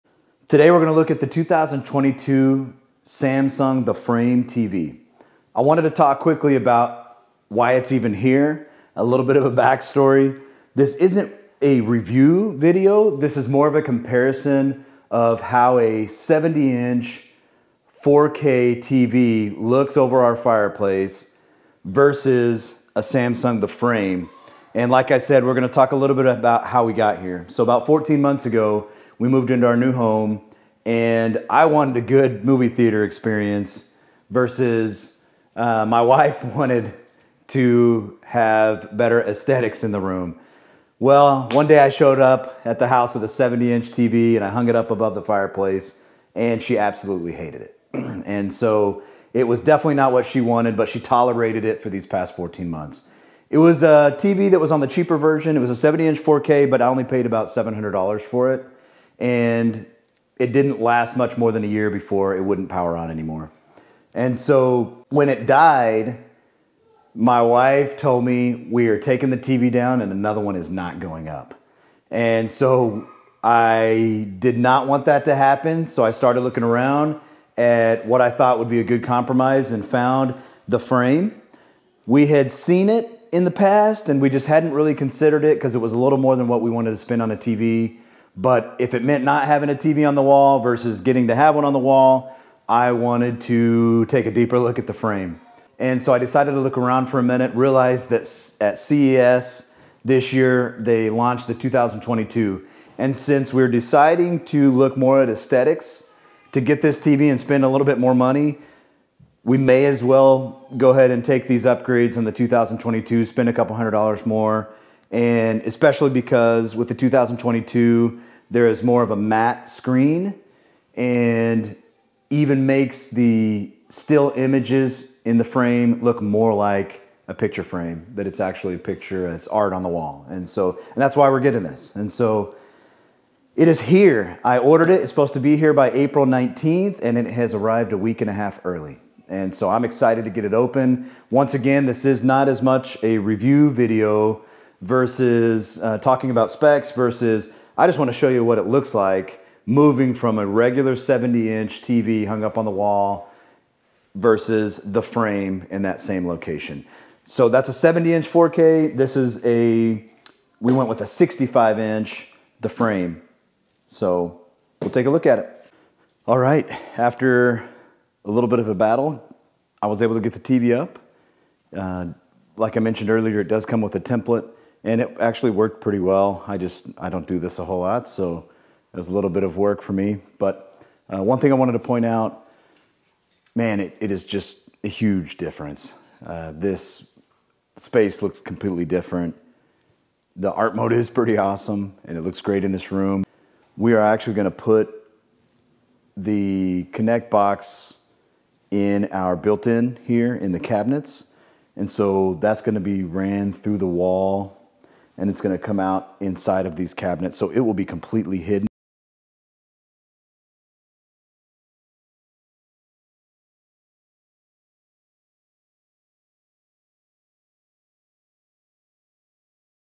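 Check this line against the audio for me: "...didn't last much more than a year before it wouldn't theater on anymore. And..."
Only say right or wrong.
wrong.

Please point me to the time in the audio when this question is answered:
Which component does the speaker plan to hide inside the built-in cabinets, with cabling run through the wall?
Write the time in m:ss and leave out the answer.
3:16.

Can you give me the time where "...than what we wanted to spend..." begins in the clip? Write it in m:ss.
1:26.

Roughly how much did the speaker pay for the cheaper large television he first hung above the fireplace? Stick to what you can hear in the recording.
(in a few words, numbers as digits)
$700.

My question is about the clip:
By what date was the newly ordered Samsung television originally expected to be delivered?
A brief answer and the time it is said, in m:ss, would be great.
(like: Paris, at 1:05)
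April 19th, at 2:15.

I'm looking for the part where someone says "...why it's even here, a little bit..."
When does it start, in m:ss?
0:07.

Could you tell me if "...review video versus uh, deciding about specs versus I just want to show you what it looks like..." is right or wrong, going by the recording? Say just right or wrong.
wrong.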